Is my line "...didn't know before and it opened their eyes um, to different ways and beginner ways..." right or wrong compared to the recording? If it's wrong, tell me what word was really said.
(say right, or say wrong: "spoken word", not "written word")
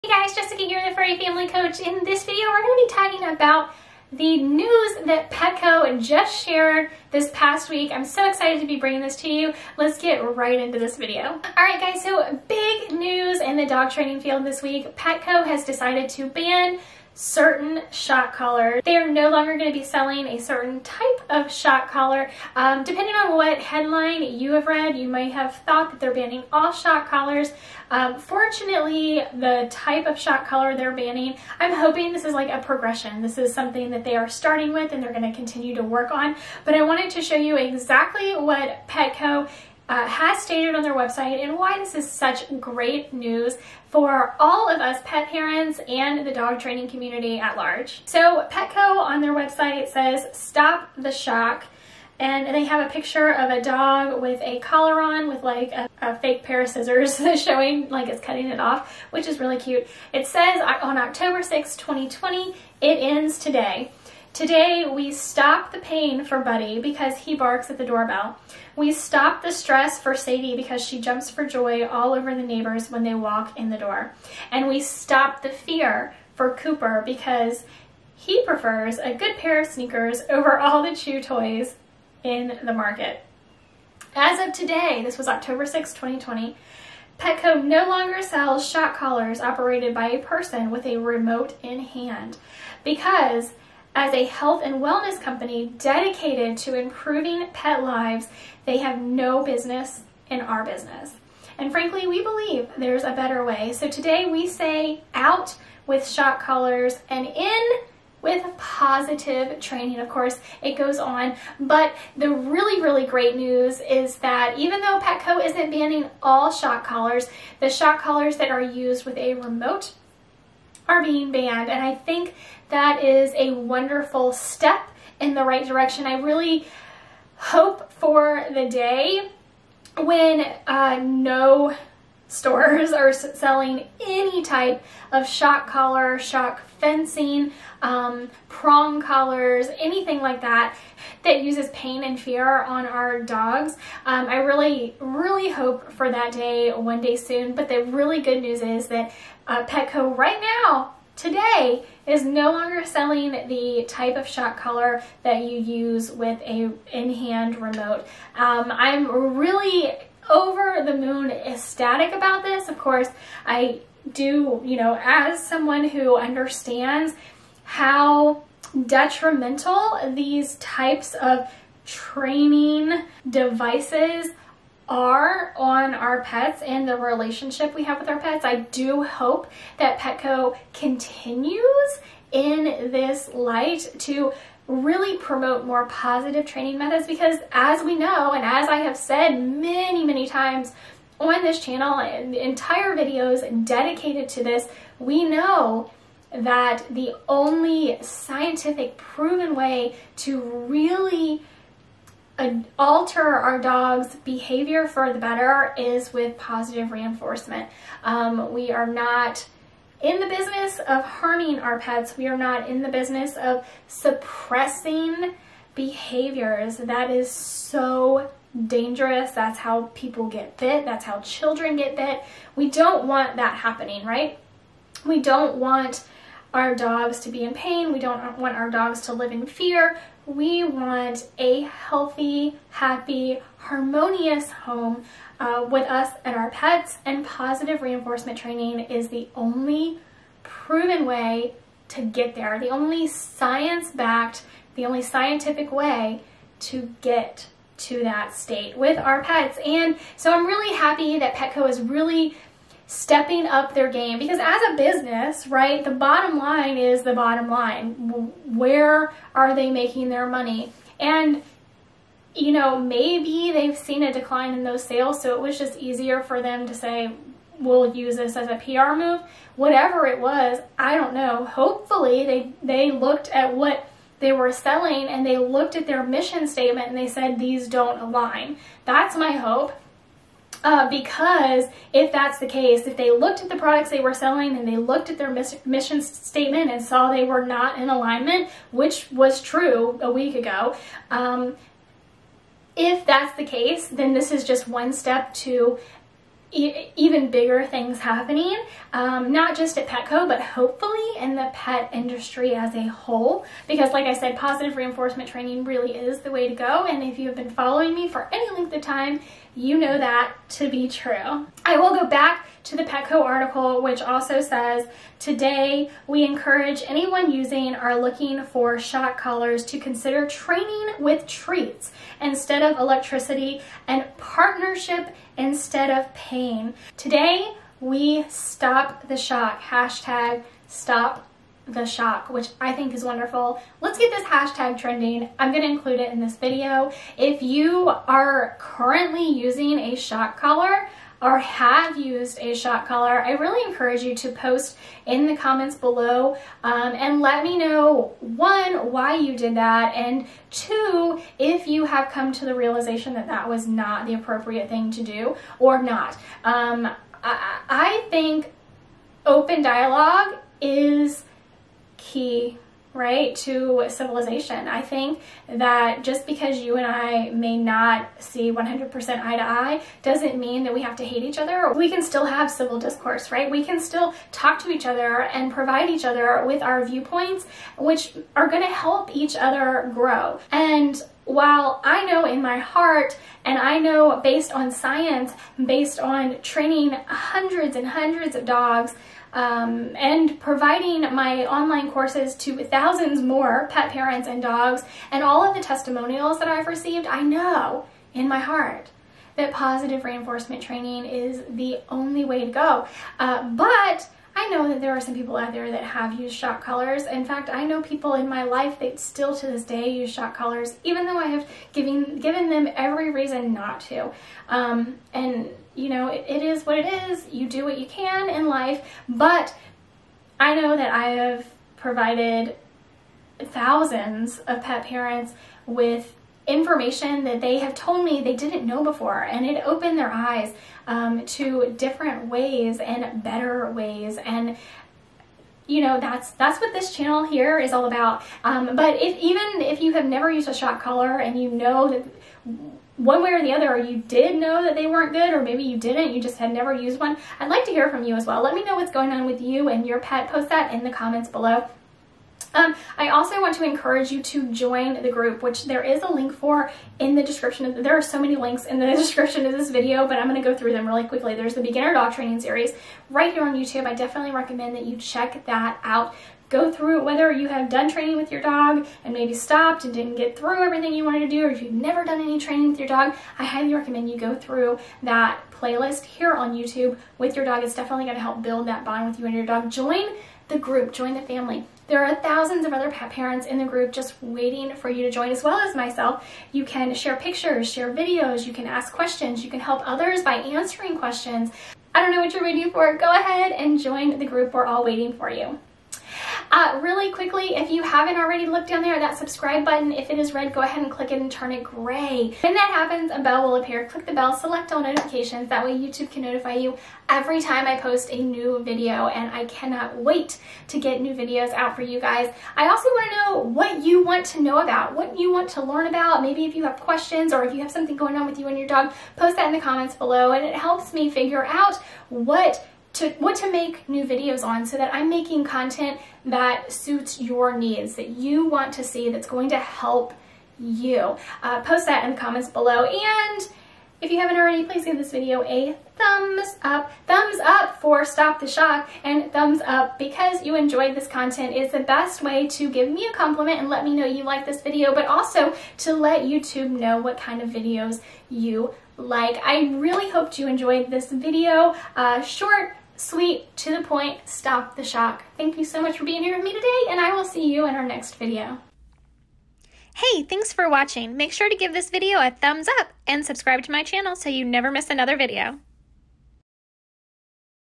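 wrong: "better", not "beginner".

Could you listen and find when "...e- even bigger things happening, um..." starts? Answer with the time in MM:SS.
04:56.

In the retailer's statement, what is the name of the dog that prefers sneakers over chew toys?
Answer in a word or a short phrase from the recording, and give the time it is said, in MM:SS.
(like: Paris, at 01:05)
Cooper, at 01:16.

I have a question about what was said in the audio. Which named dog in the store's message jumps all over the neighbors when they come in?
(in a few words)
Sadie.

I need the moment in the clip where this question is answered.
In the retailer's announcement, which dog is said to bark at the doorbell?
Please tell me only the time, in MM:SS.
01:06.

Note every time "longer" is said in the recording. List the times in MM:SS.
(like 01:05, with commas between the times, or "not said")
00:19, 01:27, 02:32.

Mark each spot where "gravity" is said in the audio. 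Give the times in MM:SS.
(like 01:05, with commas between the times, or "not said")
not said.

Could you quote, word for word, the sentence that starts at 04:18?
Where are they making their money?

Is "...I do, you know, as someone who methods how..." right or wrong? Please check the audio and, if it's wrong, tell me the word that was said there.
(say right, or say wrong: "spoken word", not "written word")
wrong: "understands", not "methods".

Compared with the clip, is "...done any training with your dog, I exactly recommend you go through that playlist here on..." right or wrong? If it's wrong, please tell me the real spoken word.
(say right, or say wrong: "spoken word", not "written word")
wrong: "highly", not "exactly".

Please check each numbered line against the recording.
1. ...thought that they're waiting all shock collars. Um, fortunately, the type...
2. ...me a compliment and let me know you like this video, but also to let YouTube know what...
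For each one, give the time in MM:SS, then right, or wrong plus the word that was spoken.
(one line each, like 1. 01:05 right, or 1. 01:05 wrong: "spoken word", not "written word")
1. 00:25 wrong: "banning", not "waiting"
2. 09:02 right.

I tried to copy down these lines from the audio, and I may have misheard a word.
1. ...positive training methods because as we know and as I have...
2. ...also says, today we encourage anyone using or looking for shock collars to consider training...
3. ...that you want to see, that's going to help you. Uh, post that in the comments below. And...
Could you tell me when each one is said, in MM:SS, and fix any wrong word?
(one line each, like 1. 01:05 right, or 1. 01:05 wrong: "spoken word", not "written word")
1. 03:05 right
2. 05:14 right
3. 08:47 right.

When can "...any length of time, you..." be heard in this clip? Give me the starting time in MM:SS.
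05:08.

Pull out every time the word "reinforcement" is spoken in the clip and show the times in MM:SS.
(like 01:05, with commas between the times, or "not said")
03:26, 03:57, 05:04, 06:40.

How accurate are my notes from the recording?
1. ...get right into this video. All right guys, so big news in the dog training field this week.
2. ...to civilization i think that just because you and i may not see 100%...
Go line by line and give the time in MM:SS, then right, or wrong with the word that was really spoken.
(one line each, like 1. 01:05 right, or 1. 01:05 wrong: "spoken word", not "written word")
1. 00:09 right
2. 06:03 right.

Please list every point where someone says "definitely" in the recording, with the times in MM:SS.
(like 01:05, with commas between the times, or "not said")
07:43, 07:57.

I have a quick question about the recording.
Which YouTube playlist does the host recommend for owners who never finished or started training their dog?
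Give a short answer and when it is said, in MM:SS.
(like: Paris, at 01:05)
beginner dog training series, at 07:41.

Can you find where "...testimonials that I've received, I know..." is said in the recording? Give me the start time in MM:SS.
06:35.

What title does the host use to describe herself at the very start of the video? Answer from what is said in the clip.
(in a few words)
Furry Family Coach.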